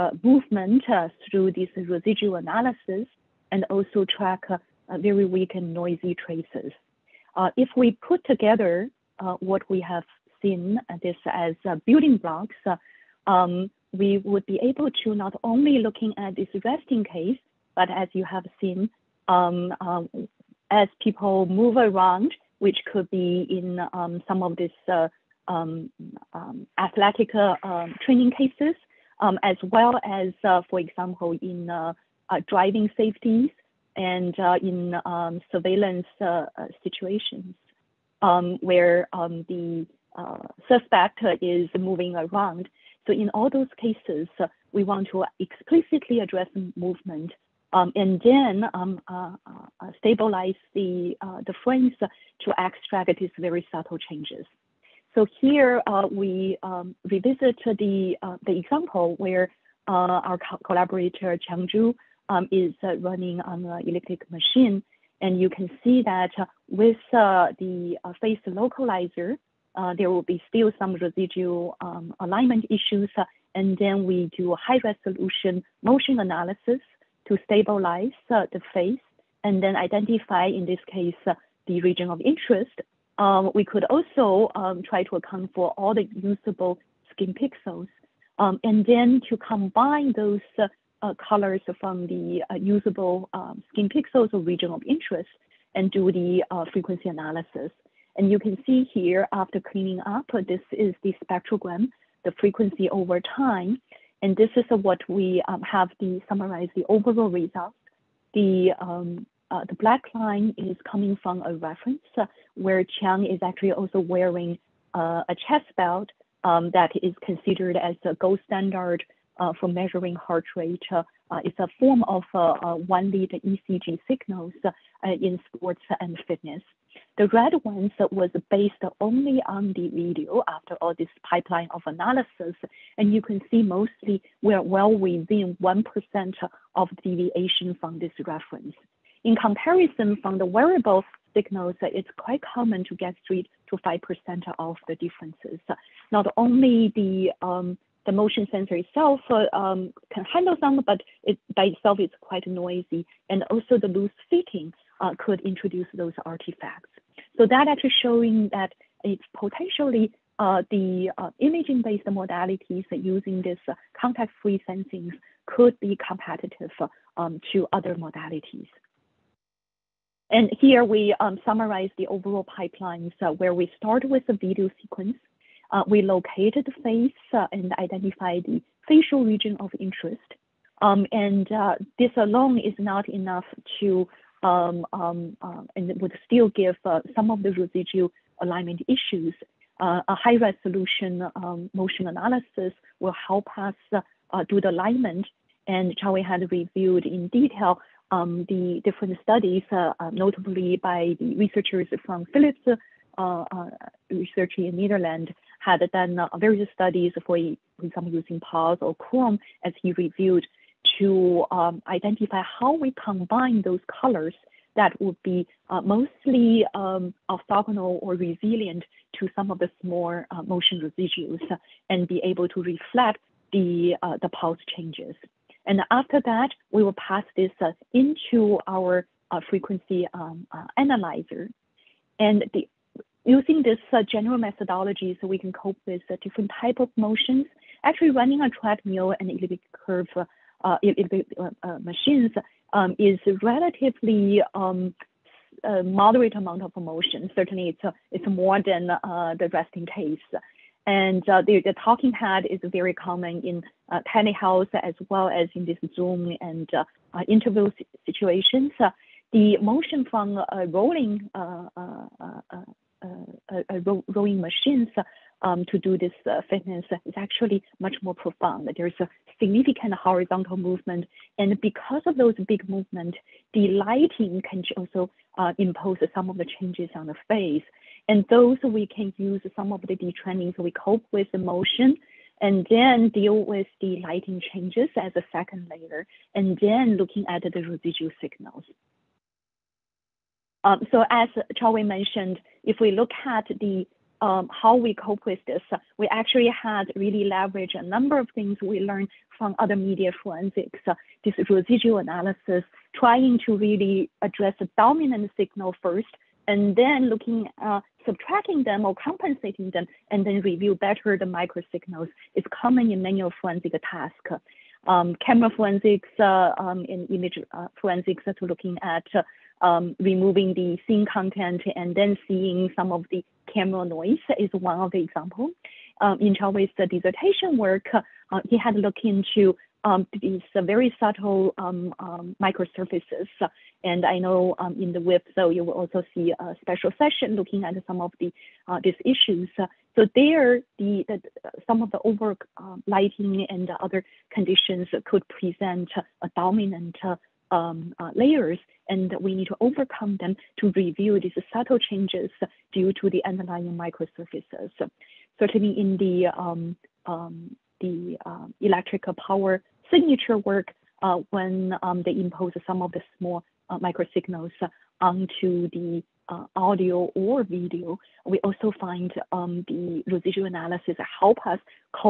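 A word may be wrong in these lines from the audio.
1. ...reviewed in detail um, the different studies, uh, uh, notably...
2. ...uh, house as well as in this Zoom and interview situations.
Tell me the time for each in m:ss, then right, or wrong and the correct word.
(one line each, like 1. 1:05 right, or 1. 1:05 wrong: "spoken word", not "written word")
1. 3:16 right
2. 4:13 right.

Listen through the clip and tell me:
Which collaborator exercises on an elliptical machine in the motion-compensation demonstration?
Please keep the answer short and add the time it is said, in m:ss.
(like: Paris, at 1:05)
Chang Zhu, at 1:01.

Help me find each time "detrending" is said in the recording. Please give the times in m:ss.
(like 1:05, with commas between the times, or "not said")
4:39.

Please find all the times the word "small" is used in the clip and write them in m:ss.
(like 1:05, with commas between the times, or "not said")
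3:39, 6:03.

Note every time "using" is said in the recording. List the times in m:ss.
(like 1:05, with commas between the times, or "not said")
2:42, 3:28, 3:53.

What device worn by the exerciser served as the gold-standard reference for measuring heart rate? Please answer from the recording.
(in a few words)
chest belt.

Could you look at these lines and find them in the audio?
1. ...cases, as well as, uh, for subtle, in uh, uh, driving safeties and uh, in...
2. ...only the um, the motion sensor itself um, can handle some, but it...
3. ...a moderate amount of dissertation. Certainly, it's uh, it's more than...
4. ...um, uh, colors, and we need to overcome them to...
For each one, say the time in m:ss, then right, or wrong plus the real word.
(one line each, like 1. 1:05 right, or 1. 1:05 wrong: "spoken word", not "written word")
1. 0:28 wrong: "example", not "subtle"
2. 2:26 right
3. 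4:05 wrong: "motion", not "dissertation"
4. 5:47 wrong: "layers", not "colors".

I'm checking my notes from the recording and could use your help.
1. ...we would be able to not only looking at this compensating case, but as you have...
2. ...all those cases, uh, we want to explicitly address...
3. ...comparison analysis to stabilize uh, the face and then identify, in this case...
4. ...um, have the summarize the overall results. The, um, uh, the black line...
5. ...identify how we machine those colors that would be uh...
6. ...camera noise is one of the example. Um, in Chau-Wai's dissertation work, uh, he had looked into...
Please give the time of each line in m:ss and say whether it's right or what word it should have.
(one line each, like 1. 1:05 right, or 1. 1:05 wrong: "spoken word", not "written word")
1. 0:13 wrong: "resting", not "compensating"
2. 0:43 right
3. 1:15 wrong: "motion", not "comparison"
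4. 1:45 right
5. 3:31 wrong: "combine", not "machine"
6. 5:23 right.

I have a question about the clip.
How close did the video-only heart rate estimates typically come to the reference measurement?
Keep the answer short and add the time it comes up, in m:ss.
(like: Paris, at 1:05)
within 1%, at 2:14.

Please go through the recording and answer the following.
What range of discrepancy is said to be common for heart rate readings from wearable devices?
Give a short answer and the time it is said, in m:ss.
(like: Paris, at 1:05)
3 to 5%, at 2:23.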